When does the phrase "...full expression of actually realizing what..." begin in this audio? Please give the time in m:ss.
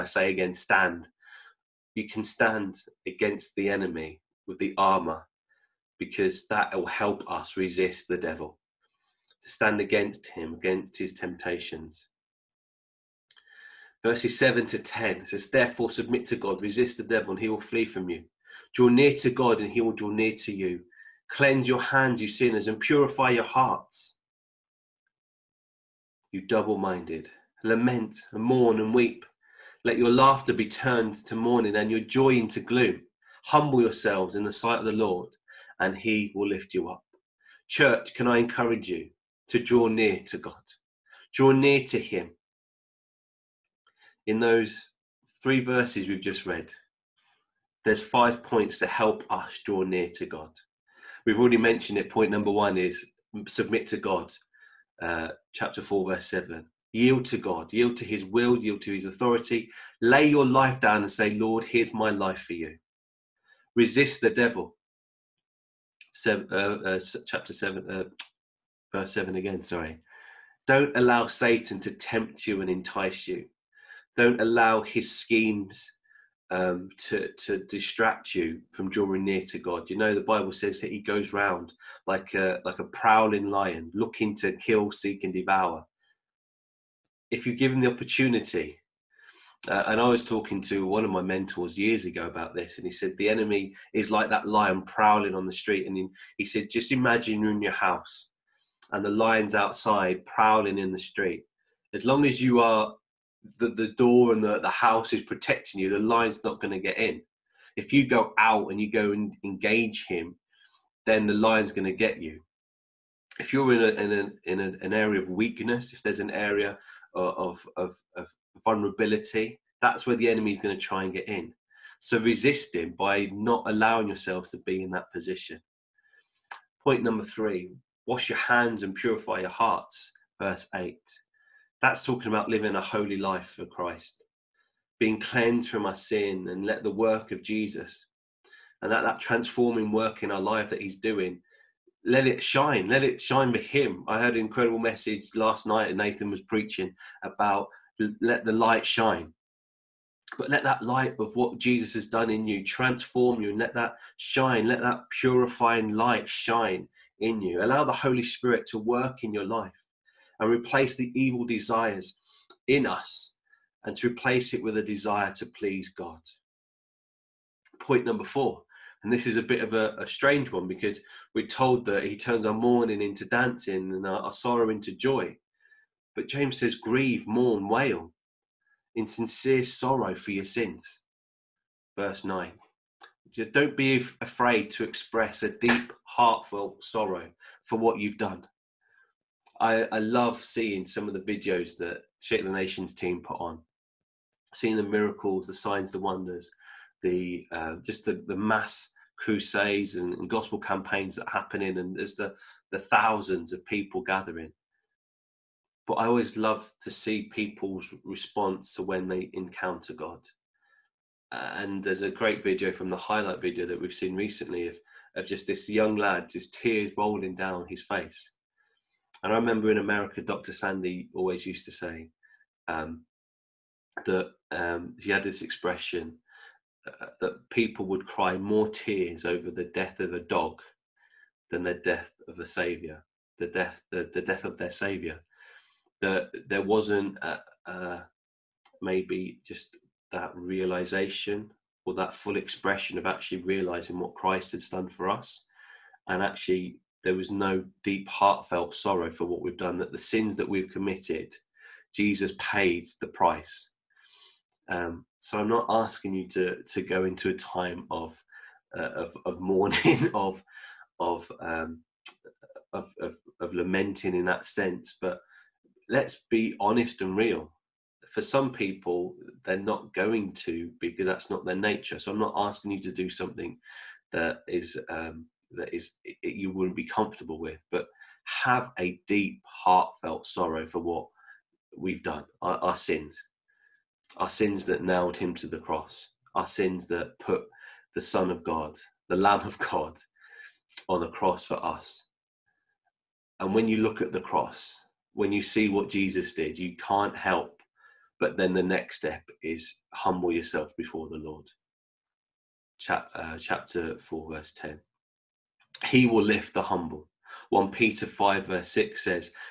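4:02.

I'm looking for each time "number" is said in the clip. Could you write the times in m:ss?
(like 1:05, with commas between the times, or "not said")
0:52, 2:07, 2:48.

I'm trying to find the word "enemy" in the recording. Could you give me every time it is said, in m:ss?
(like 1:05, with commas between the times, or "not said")
0:03, 1:33, 2:00.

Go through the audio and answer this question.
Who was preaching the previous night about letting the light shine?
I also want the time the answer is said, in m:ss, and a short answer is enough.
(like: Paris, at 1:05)
Nathan, at 2:25.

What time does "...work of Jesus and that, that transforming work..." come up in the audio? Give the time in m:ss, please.
2:16.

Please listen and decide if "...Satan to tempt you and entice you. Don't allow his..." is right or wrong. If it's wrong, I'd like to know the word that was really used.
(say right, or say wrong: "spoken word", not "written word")
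right.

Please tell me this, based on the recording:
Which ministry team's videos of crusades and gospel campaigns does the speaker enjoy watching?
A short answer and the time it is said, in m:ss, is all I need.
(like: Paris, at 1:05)
Shake the Nations, at 3:12.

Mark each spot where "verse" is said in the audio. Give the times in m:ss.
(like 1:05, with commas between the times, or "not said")
0:14, 0:45, 0:56, 1:08, 2:10, 3:01, 5:04, 5:08.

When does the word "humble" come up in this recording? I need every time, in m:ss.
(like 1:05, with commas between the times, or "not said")
0:33, 4:59, 5:06.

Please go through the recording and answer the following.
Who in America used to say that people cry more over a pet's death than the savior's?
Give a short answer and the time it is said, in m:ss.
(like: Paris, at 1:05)
Dr. Sandy, at 3:40.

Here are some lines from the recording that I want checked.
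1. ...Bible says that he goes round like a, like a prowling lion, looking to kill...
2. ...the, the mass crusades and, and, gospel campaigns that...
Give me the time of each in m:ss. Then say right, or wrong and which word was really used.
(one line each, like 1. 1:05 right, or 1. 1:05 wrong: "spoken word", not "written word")
1. 1:20 right
2. 3:18 right.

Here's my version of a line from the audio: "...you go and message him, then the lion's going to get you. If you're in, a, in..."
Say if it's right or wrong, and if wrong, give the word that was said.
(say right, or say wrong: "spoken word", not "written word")
wrong: "engage", not "message".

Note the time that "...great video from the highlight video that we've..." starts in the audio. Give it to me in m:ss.
3:32.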